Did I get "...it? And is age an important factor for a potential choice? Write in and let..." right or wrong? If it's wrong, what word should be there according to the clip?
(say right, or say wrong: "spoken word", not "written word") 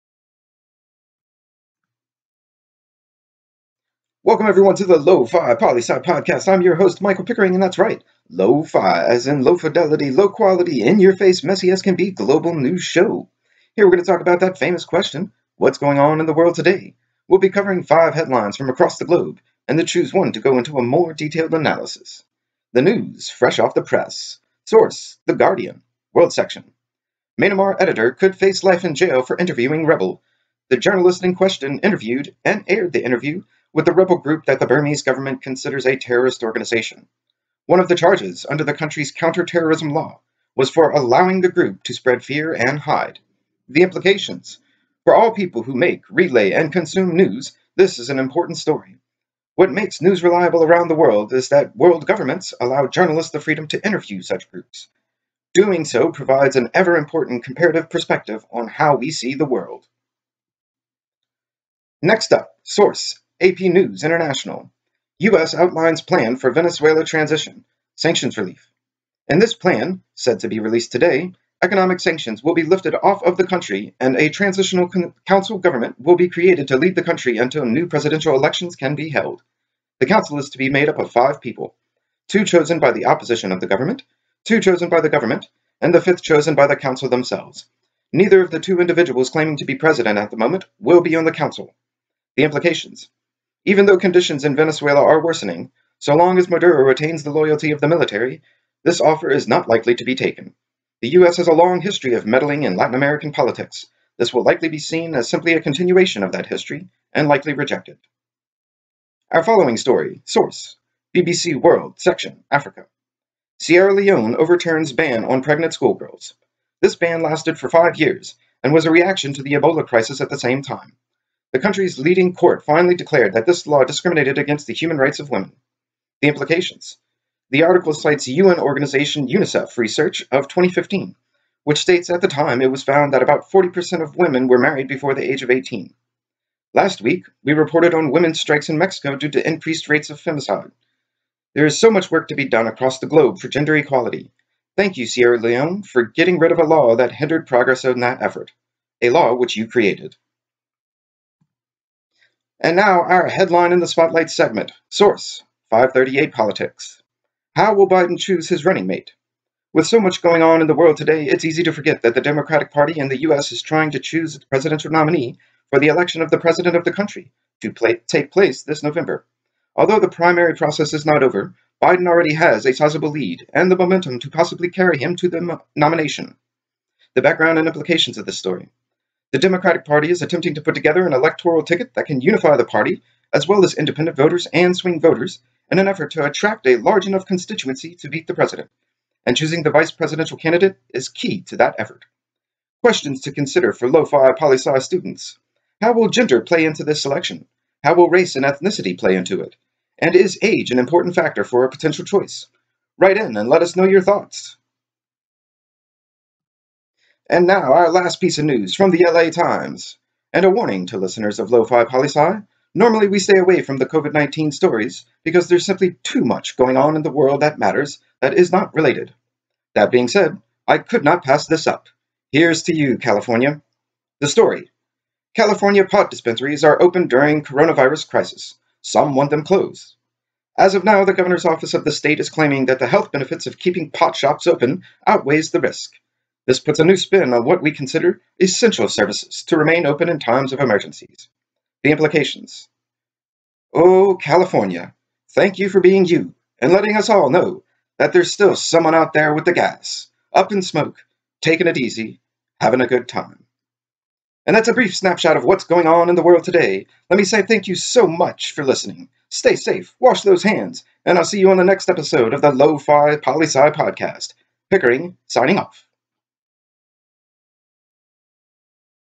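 right.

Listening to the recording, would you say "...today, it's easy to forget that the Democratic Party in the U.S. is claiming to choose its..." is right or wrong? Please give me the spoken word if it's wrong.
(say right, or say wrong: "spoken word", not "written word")
wrong: "trying", not "claiming".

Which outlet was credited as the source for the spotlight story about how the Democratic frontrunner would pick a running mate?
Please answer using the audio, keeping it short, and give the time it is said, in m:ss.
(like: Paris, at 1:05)
538 Politics, at 2:35.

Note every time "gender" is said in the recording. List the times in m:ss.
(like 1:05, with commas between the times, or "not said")
2:23, 3:16.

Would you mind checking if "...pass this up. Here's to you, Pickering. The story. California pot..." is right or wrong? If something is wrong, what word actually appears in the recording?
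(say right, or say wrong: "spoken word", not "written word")
wrong: "California", not "Pickering".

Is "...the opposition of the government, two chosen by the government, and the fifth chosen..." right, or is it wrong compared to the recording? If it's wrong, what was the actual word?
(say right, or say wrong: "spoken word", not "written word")
right.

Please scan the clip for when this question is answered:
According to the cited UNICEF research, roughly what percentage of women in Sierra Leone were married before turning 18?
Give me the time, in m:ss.
2:13.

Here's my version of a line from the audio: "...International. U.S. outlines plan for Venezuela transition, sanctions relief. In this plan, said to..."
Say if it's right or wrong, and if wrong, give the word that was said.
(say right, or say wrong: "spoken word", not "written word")
right.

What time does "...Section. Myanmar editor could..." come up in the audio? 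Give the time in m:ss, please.
0:26.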